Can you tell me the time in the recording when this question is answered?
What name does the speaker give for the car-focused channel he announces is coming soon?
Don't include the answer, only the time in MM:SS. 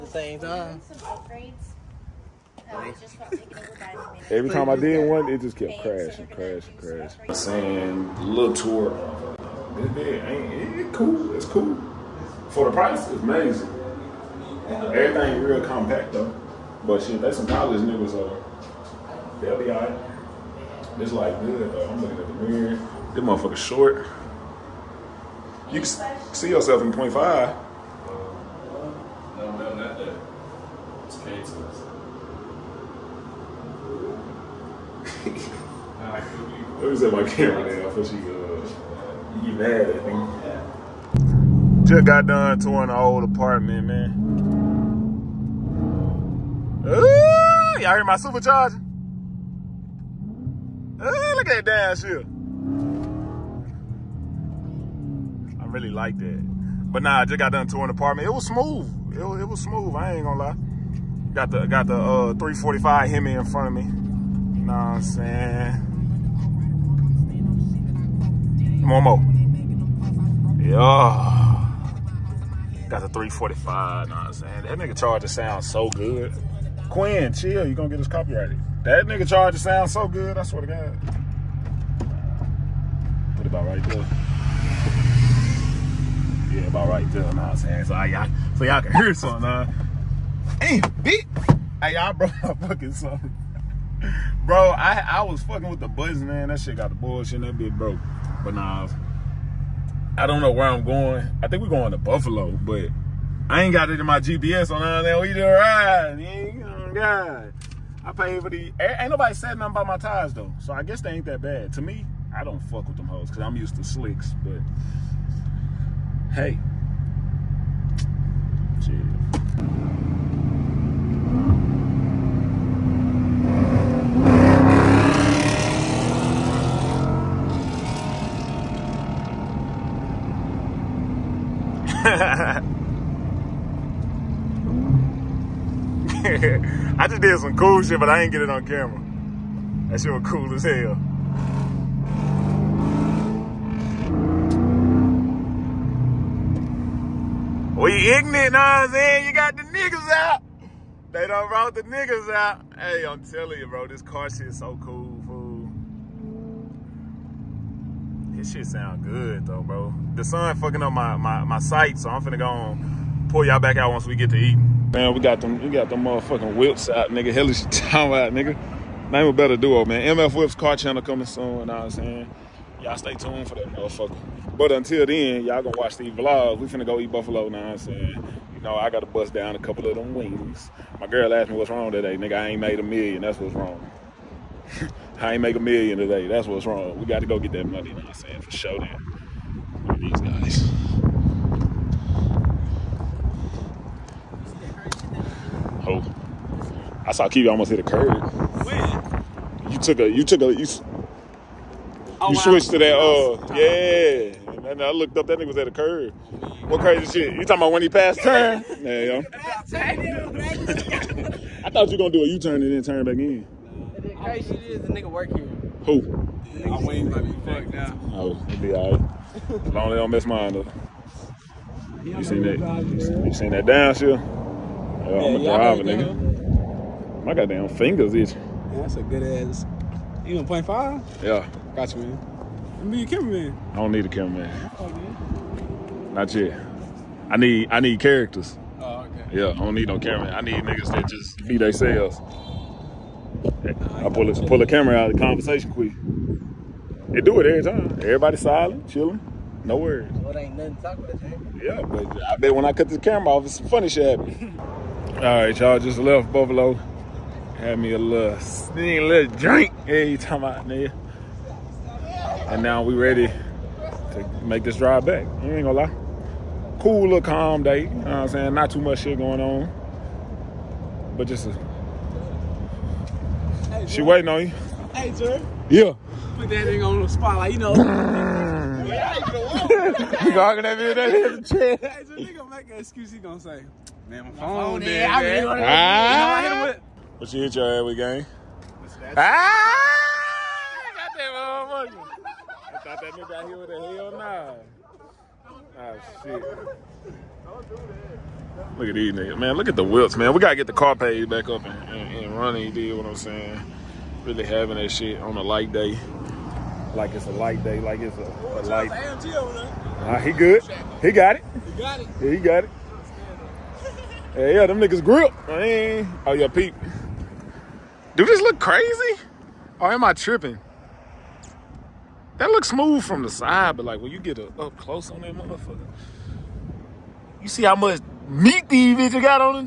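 02:50.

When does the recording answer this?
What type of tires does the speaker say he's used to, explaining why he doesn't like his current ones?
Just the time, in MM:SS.
01:53.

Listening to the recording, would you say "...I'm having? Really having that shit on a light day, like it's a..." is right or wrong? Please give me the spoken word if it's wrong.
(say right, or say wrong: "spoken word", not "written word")
wrong: "saying", not "having".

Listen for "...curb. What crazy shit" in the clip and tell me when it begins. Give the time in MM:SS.
03:25.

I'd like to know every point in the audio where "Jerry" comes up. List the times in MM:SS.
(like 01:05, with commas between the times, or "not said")
04:35, 04:42.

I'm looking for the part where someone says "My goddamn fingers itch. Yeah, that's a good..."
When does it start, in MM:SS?
03:47.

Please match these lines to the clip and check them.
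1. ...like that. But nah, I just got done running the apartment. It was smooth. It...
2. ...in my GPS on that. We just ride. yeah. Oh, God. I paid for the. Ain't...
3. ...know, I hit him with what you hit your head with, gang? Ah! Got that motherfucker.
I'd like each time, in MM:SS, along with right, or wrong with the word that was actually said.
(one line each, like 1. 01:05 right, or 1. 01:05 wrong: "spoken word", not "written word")
1. 00:55 wrong: "touring", not "running"
2. 01:43 right
3. 04:45 right.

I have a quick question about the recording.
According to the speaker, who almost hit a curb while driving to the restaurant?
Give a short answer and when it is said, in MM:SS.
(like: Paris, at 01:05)
Kiwi, at 03:17.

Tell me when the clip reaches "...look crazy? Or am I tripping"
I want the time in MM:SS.
05:18.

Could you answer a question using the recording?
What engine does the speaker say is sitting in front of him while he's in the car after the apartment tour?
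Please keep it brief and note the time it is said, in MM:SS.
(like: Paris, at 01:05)
345 Hemi, at 01:02.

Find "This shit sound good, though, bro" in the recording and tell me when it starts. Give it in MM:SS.
02:38.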